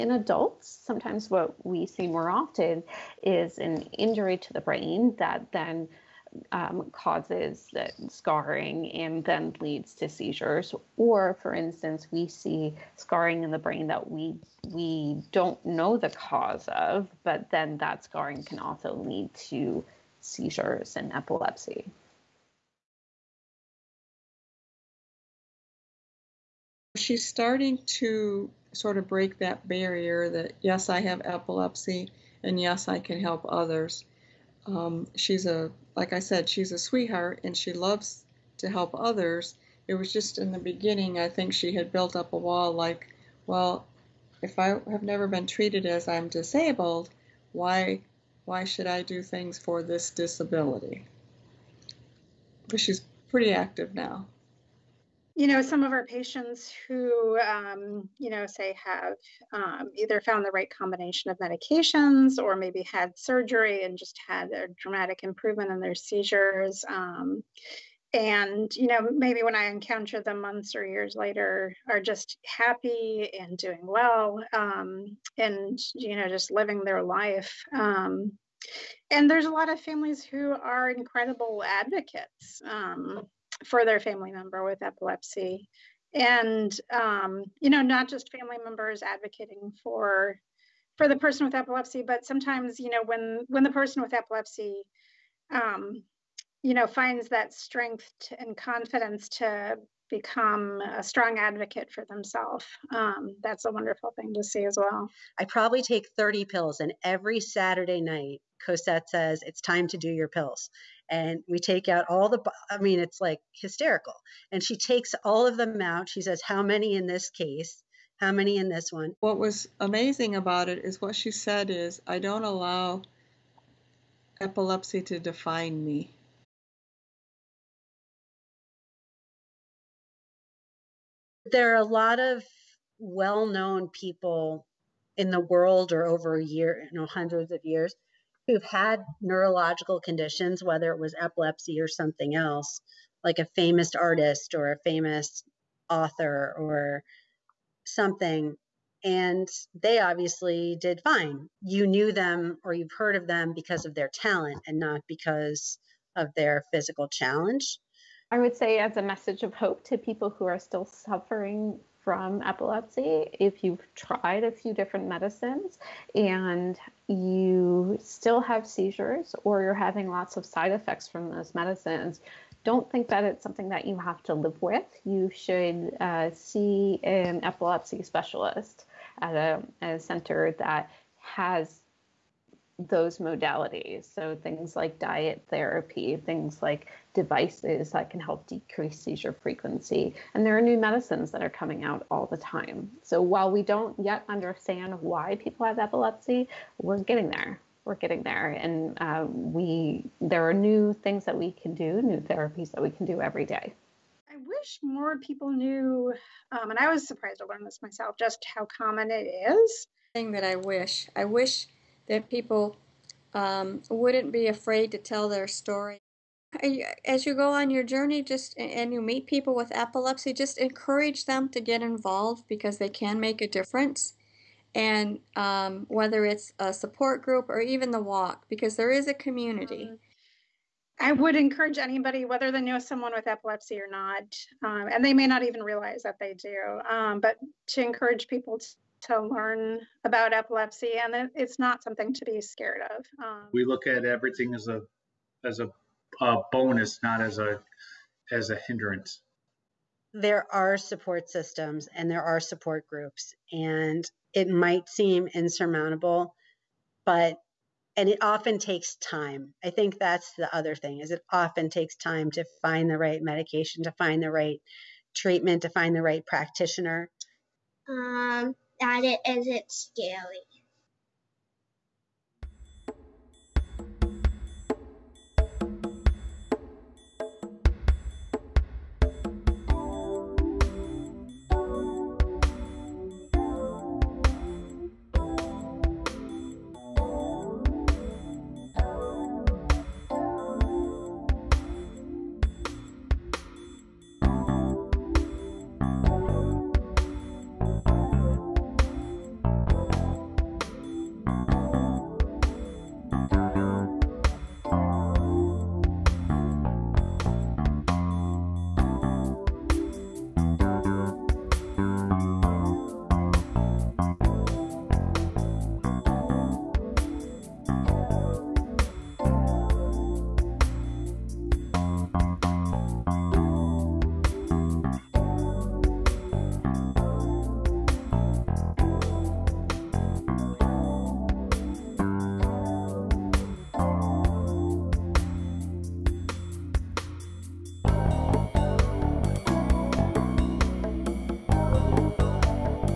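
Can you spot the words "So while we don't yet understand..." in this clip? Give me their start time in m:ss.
3:13.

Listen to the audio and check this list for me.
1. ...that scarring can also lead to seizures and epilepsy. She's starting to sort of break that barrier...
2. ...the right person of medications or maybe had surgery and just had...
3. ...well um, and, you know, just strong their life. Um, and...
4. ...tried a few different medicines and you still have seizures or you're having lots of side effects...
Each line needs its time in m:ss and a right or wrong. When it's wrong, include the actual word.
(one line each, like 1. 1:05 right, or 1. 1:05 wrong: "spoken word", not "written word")
1. 0:17 right
2. 1:00 wrong: "combination", not "person"
3. 1:13 wrong: "living", not "strong"
4. 2:43 right.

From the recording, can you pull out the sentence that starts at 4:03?
we look at everything as a as a a bonus, not as a as a hindrance.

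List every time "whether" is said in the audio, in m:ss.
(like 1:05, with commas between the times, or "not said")
2:20, 3:45, 3:52.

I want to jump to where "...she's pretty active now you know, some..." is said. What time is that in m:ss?
0:52.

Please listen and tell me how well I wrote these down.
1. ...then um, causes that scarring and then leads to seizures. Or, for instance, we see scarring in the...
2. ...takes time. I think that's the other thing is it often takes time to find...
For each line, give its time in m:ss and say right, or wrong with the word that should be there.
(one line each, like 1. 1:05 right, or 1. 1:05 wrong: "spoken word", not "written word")
1. 0:05 right
2. 4:18 right.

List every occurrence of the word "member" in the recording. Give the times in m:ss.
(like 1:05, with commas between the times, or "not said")
1:24, 1:28.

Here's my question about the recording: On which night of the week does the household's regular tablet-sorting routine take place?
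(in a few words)
Saturday.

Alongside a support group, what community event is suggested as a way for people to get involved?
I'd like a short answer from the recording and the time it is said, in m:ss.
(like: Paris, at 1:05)
The walk, at 3:47.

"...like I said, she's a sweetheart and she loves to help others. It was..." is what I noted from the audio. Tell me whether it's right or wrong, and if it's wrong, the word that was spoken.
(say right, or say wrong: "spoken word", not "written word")
right.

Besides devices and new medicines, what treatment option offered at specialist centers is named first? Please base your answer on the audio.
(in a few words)
Diet therapy.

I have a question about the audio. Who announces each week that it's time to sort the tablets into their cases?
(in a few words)
Cosette.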